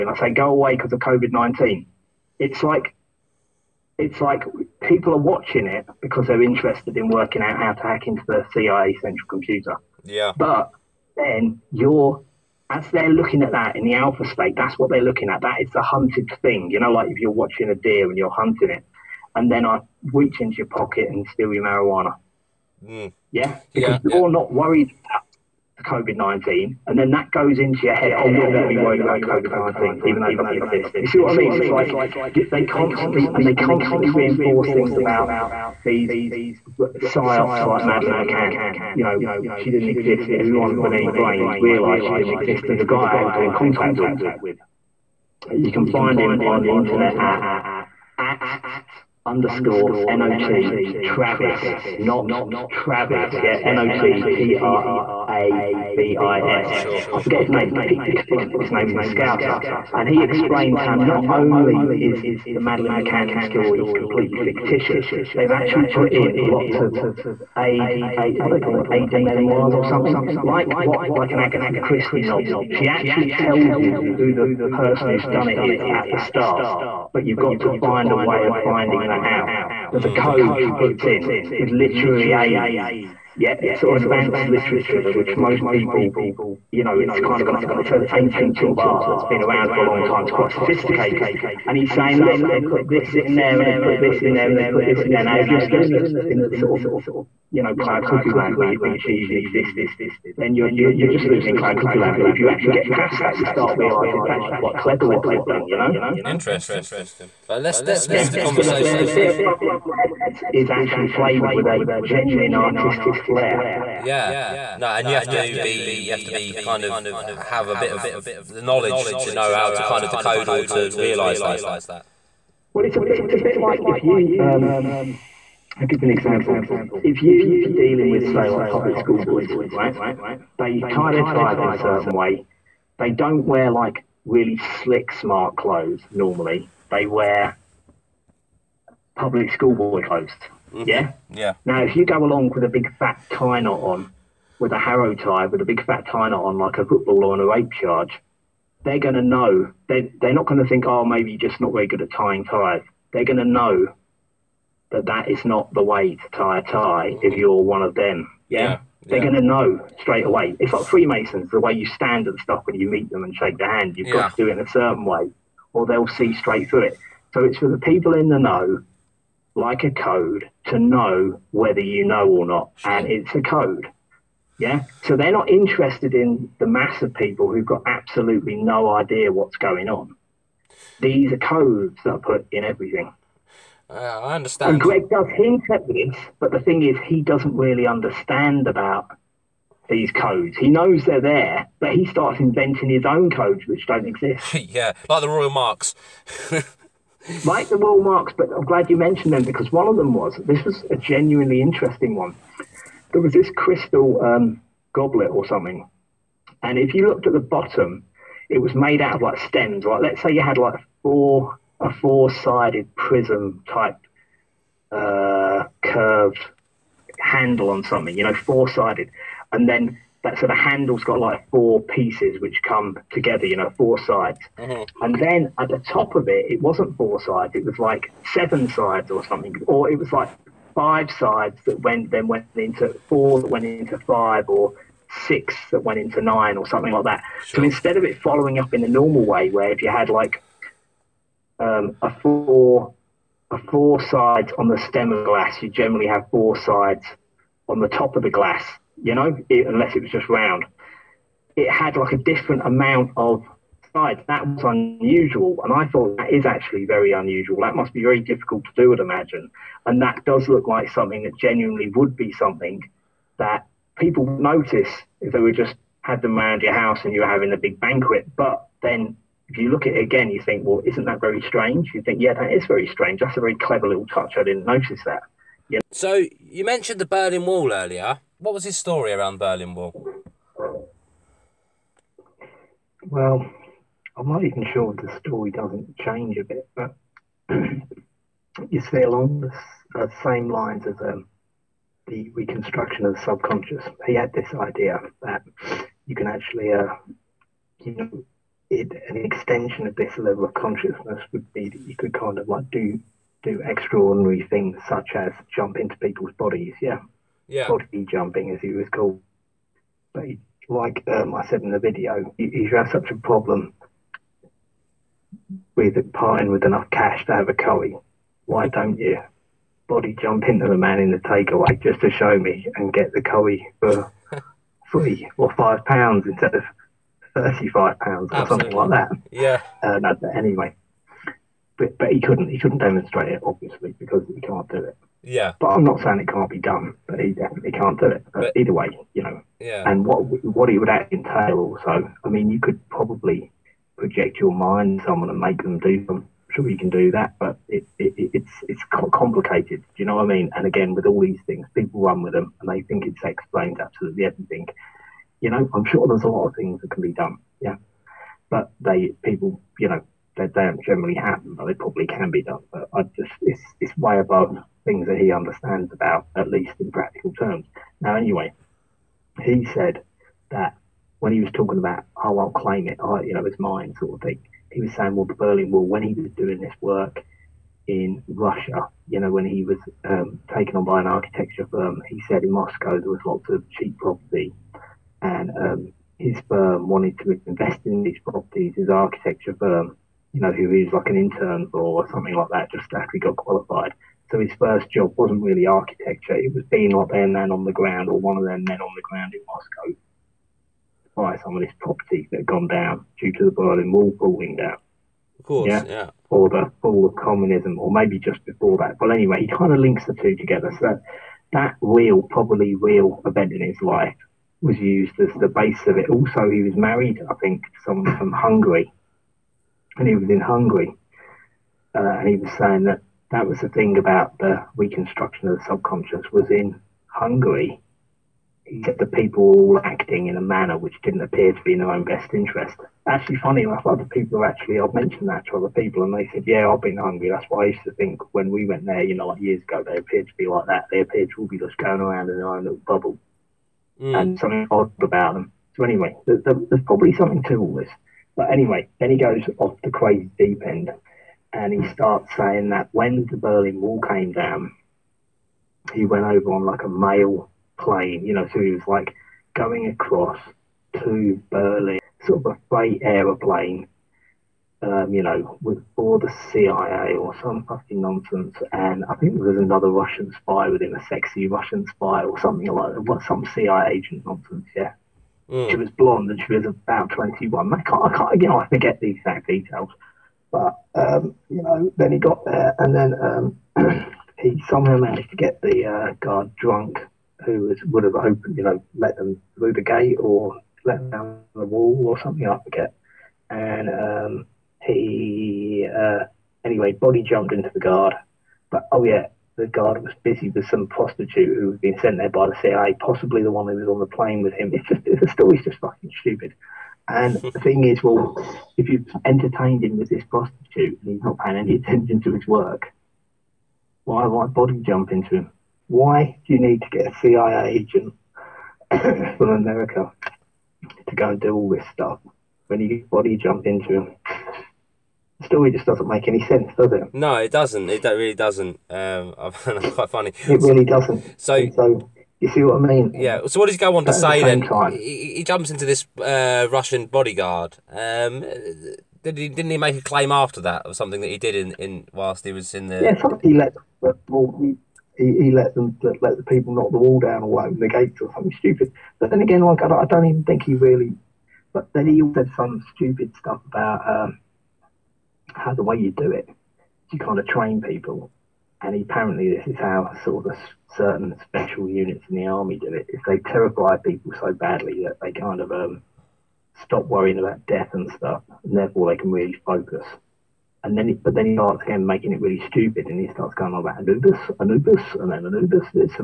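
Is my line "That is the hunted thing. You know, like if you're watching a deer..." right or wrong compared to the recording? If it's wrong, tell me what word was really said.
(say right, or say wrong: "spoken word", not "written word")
right.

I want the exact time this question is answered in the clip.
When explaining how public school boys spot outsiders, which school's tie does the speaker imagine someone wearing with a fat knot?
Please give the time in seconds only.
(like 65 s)
144 s.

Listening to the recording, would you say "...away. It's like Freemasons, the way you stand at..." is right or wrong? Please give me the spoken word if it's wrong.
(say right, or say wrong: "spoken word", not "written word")
right.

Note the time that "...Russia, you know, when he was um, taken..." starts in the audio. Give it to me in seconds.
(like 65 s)
378 s.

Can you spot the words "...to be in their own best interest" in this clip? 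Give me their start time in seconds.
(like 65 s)
431 s.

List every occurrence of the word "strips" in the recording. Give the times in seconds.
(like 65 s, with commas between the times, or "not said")
not said.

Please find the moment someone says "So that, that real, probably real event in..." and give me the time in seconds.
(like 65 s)
410 s.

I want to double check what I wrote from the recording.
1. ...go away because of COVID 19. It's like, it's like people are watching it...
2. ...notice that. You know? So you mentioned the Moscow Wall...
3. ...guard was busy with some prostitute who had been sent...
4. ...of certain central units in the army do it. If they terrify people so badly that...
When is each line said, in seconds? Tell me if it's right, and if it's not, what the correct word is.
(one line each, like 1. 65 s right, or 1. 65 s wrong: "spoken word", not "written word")
1. 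0 s right
2. 274 s wrong: "Berlin", not "Moscow"
3. 499 s right
4. 560 s wrong: "special", not "central".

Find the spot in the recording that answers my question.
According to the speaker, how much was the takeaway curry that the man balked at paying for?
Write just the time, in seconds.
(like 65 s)
327 s.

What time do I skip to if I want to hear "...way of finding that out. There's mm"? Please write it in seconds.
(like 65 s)
78 s.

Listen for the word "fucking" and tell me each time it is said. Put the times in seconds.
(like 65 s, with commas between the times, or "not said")
467 s, 505 s.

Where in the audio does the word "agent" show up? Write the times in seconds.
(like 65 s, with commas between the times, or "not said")
473 s, 517 s.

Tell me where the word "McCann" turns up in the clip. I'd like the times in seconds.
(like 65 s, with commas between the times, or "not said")
38 s, 62 s.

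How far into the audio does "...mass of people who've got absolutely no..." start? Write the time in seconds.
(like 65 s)
176 s.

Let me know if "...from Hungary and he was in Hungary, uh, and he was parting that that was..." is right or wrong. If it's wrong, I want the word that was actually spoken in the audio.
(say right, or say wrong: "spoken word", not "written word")
wrong: "saying", not "parting".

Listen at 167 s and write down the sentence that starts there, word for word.
So it's for the people in the know like a code to know whether you know or not, and it's a code.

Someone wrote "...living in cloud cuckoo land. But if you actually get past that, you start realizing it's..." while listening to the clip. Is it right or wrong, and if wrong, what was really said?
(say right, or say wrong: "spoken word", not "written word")
right.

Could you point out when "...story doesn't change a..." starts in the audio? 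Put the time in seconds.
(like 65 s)
285 s.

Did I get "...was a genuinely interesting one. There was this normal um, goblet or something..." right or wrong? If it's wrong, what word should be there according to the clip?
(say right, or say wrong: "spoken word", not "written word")
wrong: "crystal", not "normal".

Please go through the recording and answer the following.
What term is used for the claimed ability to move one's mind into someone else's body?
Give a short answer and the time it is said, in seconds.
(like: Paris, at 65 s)
body jumping, at 307 s.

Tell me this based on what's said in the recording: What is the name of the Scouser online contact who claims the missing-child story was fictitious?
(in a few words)
Peter Cullen.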